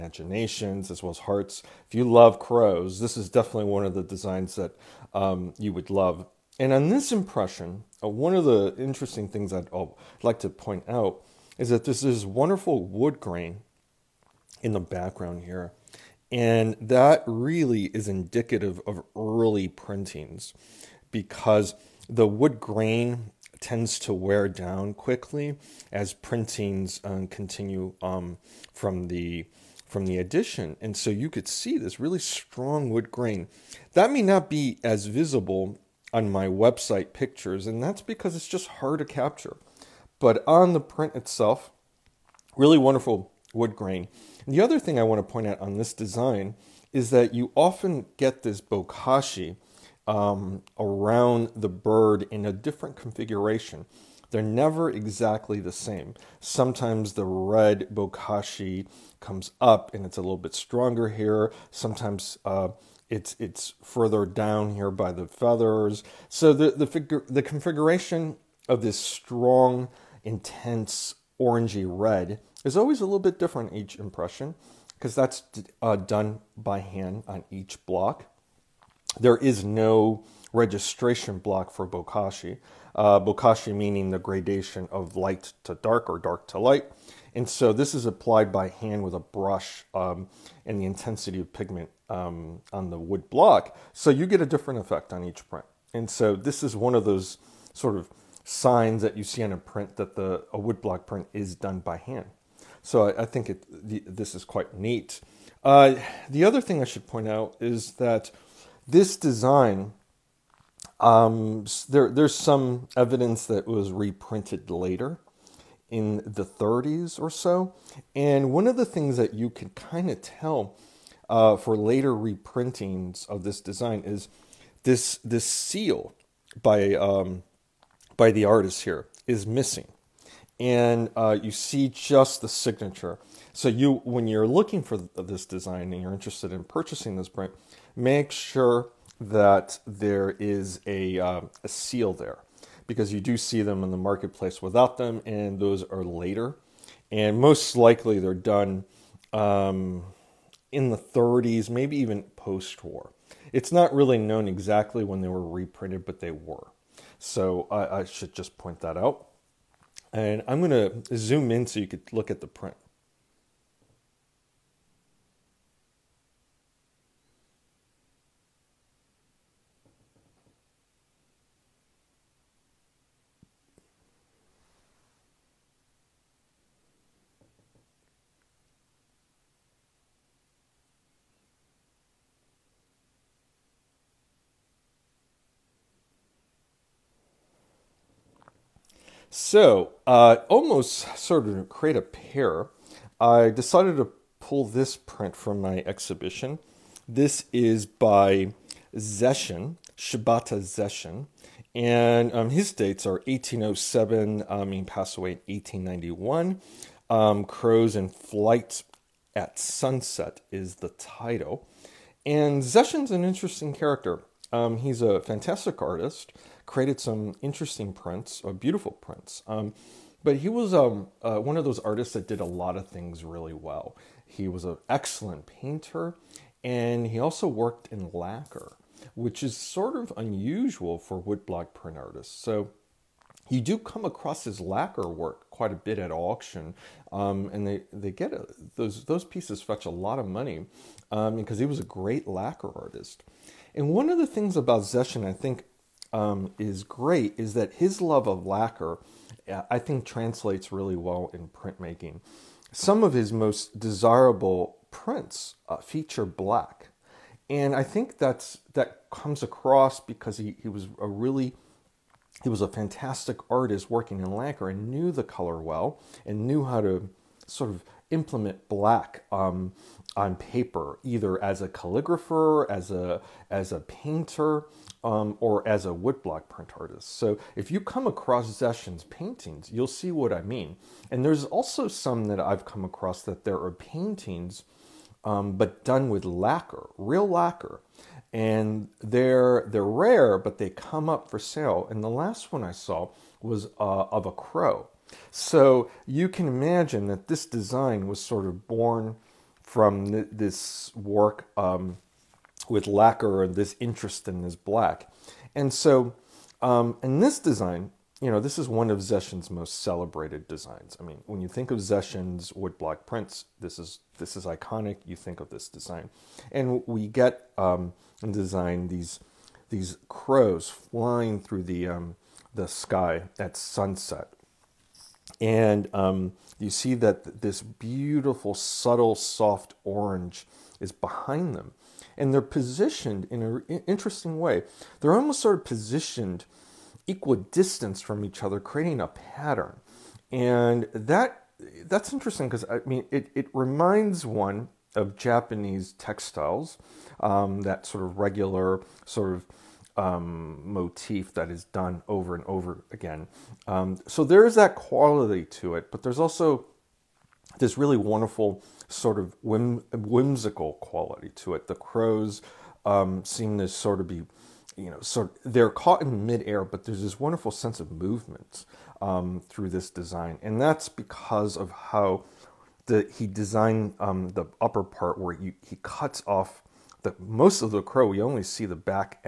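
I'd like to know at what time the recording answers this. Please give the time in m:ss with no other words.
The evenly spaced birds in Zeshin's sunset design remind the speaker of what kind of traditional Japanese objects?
5:45.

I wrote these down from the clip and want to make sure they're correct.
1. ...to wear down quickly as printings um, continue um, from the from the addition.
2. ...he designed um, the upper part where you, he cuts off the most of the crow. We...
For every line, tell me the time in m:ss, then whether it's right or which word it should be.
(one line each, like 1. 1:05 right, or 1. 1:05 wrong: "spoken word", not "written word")
1. 0:23 right
2. 6:13 right.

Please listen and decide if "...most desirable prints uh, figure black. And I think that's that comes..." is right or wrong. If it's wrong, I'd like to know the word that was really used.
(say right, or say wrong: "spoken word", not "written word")
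wrong: "feature", not "figure".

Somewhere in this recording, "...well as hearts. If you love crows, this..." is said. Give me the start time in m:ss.
0:01.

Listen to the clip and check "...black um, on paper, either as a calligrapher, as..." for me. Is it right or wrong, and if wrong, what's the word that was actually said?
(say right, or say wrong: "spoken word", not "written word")
right.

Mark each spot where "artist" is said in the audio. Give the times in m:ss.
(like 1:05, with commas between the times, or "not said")
2:08, 3:35, 3:41, 3:51, 4:02, 4:23, 4:36.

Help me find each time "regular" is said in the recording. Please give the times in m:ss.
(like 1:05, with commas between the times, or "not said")
5:48.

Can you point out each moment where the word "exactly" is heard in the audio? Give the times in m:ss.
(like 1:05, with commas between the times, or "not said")
0:54, 2:34.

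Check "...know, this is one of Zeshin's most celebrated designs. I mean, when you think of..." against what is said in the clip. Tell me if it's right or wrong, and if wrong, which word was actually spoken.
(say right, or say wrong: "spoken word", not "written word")
right.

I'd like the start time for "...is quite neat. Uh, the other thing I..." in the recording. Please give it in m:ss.
1:44.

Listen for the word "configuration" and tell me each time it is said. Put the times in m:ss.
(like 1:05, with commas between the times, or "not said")
0:52, 1:07.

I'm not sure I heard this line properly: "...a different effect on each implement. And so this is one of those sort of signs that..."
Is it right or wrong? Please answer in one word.
wrong.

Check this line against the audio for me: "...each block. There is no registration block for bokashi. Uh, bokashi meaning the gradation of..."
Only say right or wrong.
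right.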